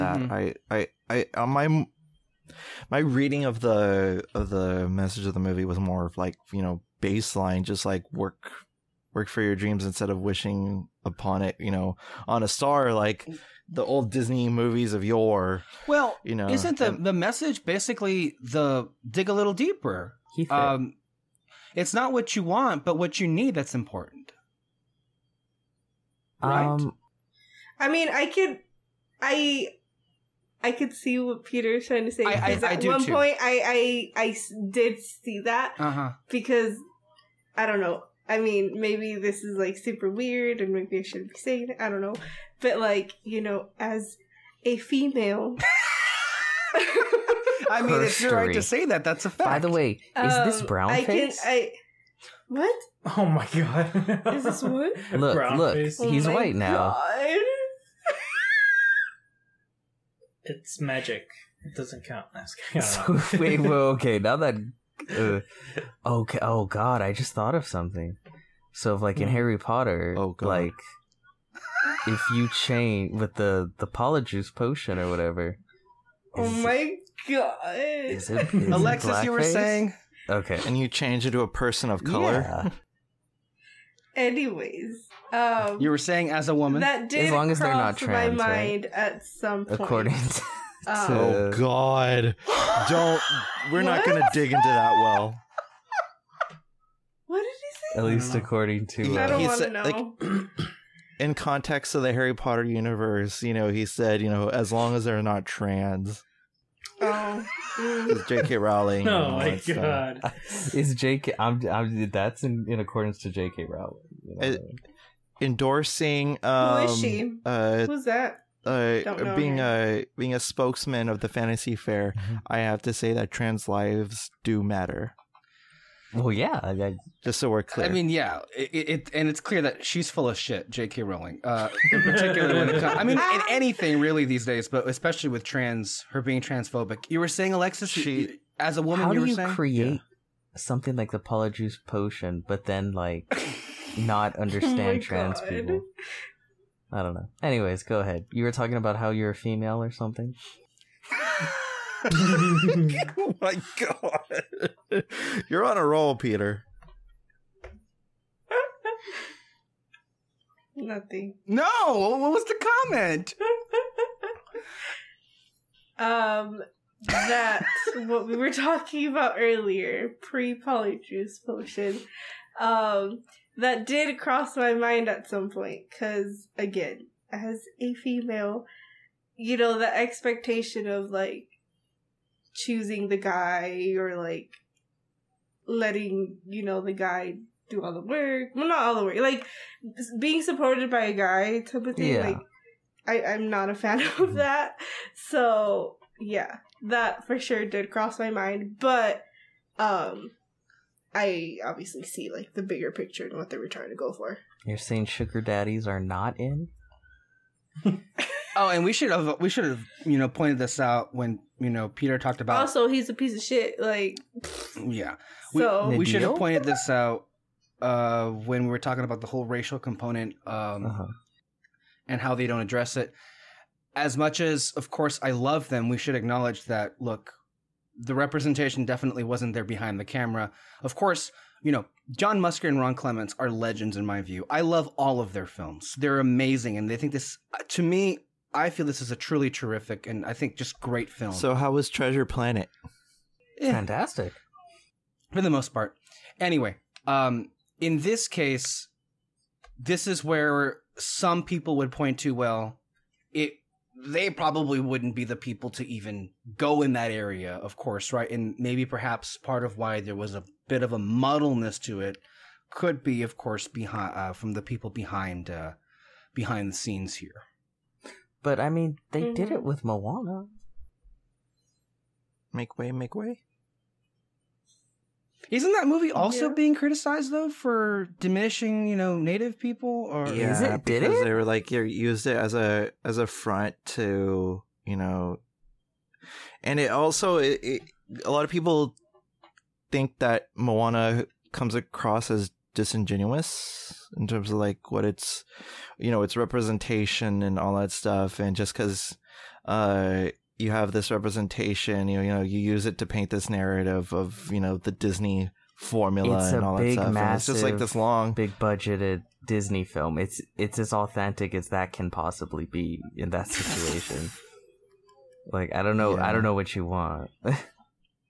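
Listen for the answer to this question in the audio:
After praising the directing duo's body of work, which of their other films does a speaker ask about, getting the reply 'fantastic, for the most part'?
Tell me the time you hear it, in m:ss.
4:01.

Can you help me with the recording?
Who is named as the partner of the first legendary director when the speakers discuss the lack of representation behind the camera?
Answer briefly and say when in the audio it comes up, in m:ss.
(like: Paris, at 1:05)
Ron Clements, at 3:52.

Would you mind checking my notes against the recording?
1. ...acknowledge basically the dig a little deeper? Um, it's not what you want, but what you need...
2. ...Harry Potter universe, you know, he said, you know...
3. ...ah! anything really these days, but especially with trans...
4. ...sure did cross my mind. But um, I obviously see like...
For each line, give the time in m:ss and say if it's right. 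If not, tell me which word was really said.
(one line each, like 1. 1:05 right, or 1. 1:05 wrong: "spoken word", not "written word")
1. 0:17 wrong: "message", not "acknowledge"
2. 1:42 right
3. 2:13 right
4. 3:17 right.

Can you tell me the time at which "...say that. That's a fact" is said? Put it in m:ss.
0:48.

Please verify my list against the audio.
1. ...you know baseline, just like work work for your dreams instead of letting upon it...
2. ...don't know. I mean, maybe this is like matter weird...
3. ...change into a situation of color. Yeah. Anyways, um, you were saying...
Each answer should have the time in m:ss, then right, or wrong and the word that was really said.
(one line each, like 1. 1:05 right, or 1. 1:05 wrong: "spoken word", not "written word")
1. 0:06 wrong: "wishing", not "letting"
2. 0:37 wrong: "super", not "matter"
3. 1:20 wrong: "person", not "situation".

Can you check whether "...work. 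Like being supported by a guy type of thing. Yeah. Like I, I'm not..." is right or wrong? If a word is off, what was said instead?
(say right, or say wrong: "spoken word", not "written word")
right.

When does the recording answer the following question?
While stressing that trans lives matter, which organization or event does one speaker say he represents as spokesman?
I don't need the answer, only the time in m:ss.
2:01.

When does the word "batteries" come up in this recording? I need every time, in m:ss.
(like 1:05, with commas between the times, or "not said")
not said.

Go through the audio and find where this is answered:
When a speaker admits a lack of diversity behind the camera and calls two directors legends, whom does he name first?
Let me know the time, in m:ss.
3:52.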